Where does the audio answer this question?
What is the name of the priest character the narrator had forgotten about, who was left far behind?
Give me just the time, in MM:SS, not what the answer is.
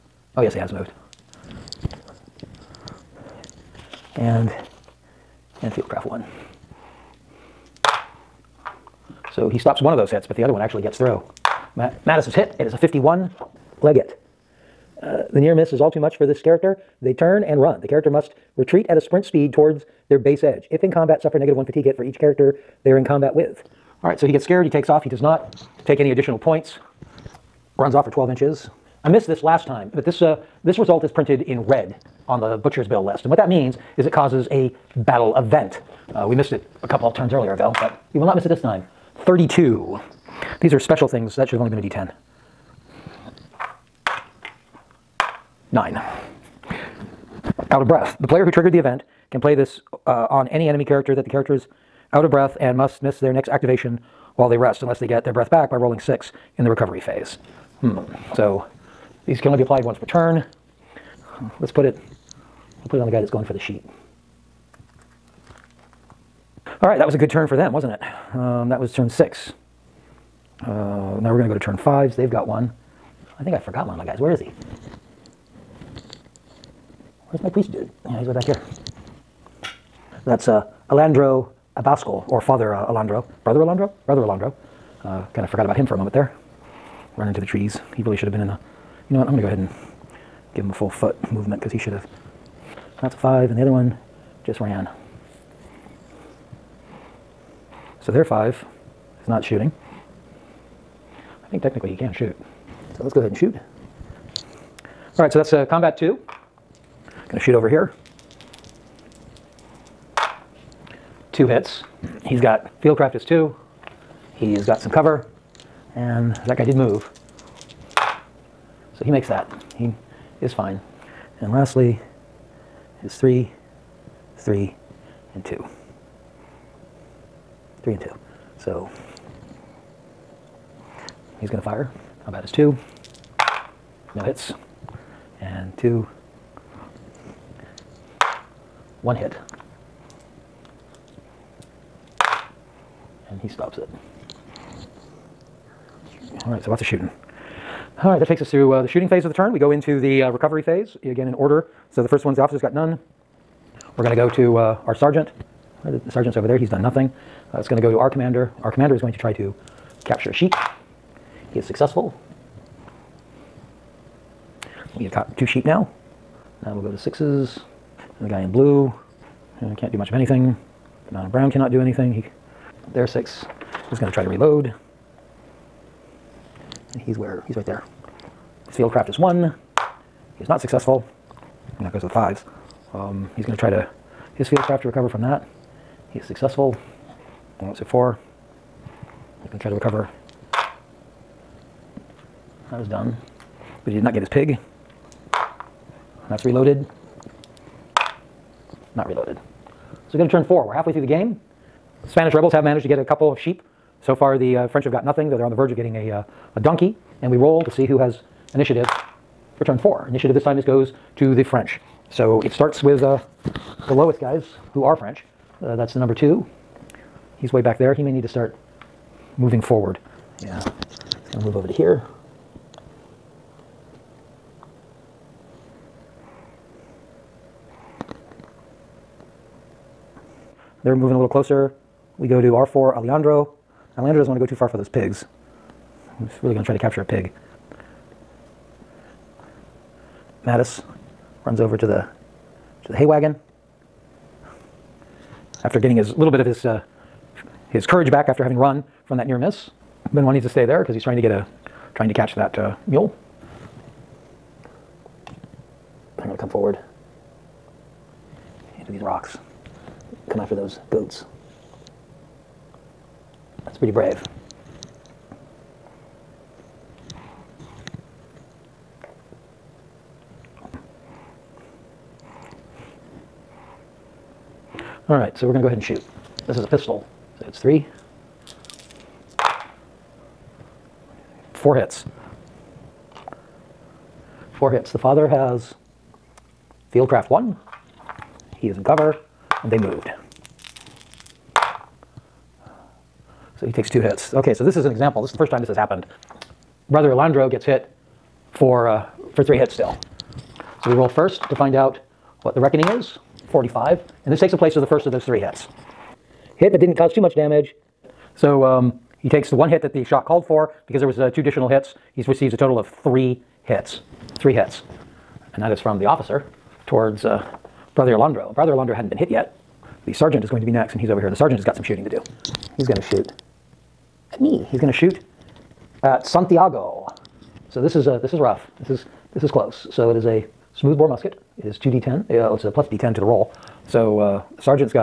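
01:20.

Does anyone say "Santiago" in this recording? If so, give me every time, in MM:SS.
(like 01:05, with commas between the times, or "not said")
05:26.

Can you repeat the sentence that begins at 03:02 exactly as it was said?
Um, he's going to try to his field craft to recover from that.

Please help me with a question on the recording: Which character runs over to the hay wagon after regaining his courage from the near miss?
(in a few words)
Mattis.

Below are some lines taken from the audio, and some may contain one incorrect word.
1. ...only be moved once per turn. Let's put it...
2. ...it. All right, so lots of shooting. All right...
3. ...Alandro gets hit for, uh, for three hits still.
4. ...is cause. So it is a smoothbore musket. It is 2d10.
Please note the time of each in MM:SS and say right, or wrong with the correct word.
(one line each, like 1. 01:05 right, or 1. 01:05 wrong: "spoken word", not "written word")
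1. 00:59 wrong: "applied", not "moved"
2. 02:23 right
3. 04:57 right
4. 05:29 wrong: "close", not "cause".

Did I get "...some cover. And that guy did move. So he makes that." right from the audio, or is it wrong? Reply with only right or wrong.
right.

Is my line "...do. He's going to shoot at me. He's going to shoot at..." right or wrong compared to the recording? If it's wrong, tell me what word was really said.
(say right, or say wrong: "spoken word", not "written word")
right.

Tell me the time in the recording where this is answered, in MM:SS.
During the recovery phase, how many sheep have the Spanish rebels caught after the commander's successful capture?
02:45.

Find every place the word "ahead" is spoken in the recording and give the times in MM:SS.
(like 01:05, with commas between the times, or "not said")
01:29, 01:43, 04:35.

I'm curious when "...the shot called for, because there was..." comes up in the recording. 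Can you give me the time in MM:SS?
05:09.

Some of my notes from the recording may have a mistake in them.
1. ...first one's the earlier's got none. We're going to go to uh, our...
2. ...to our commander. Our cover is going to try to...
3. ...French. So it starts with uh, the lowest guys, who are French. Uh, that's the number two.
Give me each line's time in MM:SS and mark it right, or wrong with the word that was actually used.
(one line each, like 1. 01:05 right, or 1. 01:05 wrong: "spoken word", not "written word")
1. 02:32 wrong: "officer", not "earlier"
2. 02:37 wrong: "commander", not "cover"
3. 03:31 right.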